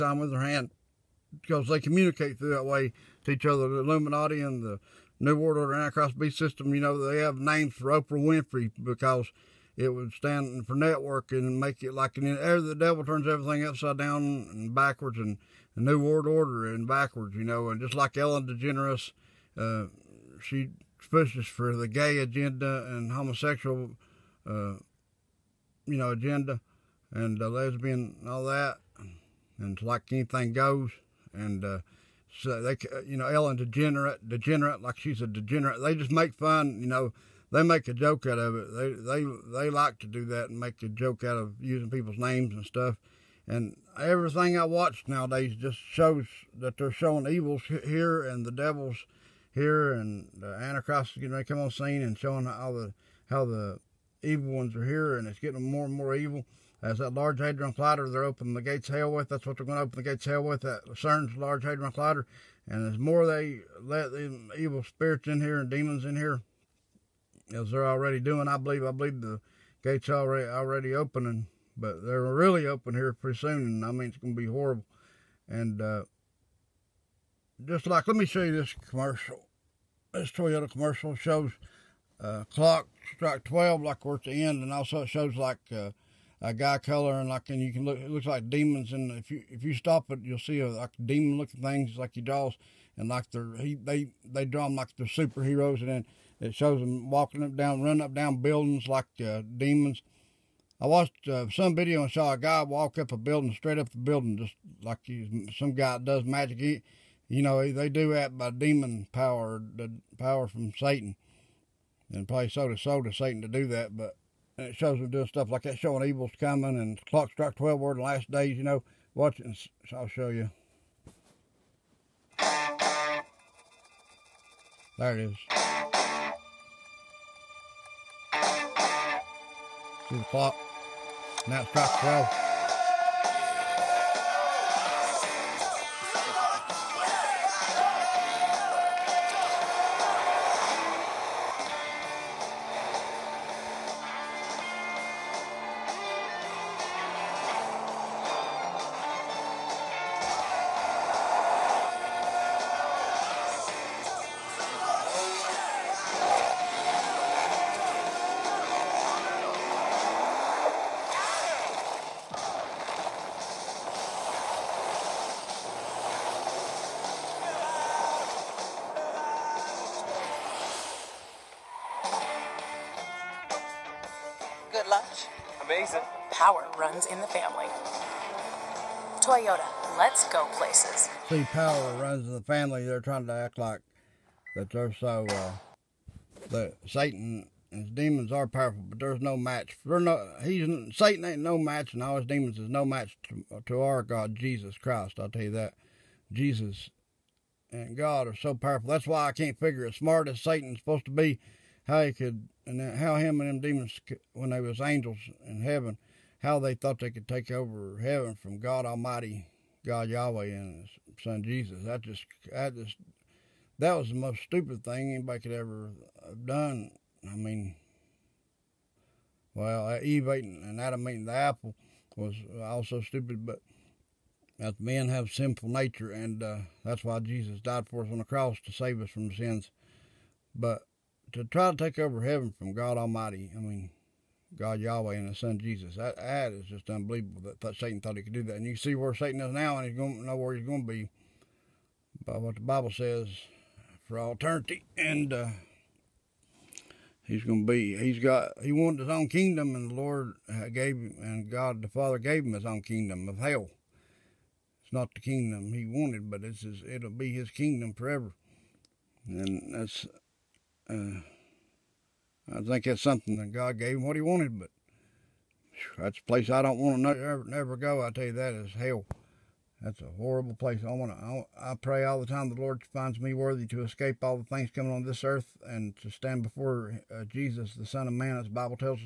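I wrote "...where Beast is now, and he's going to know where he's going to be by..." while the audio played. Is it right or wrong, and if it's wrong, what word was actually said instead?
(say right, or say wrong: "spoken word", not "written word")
wrong: "Satan", not "Beast".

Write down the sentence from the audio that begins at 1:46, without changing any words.
He, you know, they do that by demon power, the power from Satan.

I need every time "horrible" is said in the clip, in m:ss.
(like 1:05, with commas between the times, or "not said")
1:14, 4:30.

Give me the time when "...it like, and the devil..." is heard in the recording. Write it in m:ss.
0:11.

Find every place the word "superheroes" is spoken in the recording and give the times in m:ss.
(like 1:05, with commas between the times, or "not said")
1:35.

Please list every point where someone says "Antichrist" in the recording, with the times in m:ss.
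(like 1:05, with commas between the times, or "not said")
0:05, 0:50.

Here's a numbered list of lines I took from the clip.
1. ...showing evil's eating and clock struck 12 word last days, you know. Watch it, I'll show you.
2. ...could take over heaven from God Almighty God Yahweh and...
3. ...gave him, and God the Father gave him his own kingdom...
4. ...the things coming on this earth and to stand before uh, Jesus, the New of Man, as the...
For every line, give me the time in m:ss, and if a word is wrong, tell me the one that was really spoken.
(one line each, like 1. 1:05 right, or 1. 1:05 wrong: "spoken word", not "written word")
1. 1:55 wrong: "coming", not "eating"
2. 3:27 right
3. 4:10 right
4. 4:34 wrong: "Son", not "New".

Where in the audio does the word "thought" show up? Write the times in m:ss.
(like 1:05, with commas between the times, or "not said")
3:26, 3:58.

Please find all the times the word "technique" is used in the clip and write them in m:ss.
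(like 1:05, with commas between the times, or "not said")
not said.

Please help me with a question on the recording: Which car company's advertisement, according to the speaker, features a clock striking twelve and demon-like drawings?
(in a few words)
Toyota.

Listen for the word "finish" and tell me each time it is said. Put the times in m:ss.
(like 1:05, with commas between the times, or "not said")
not said.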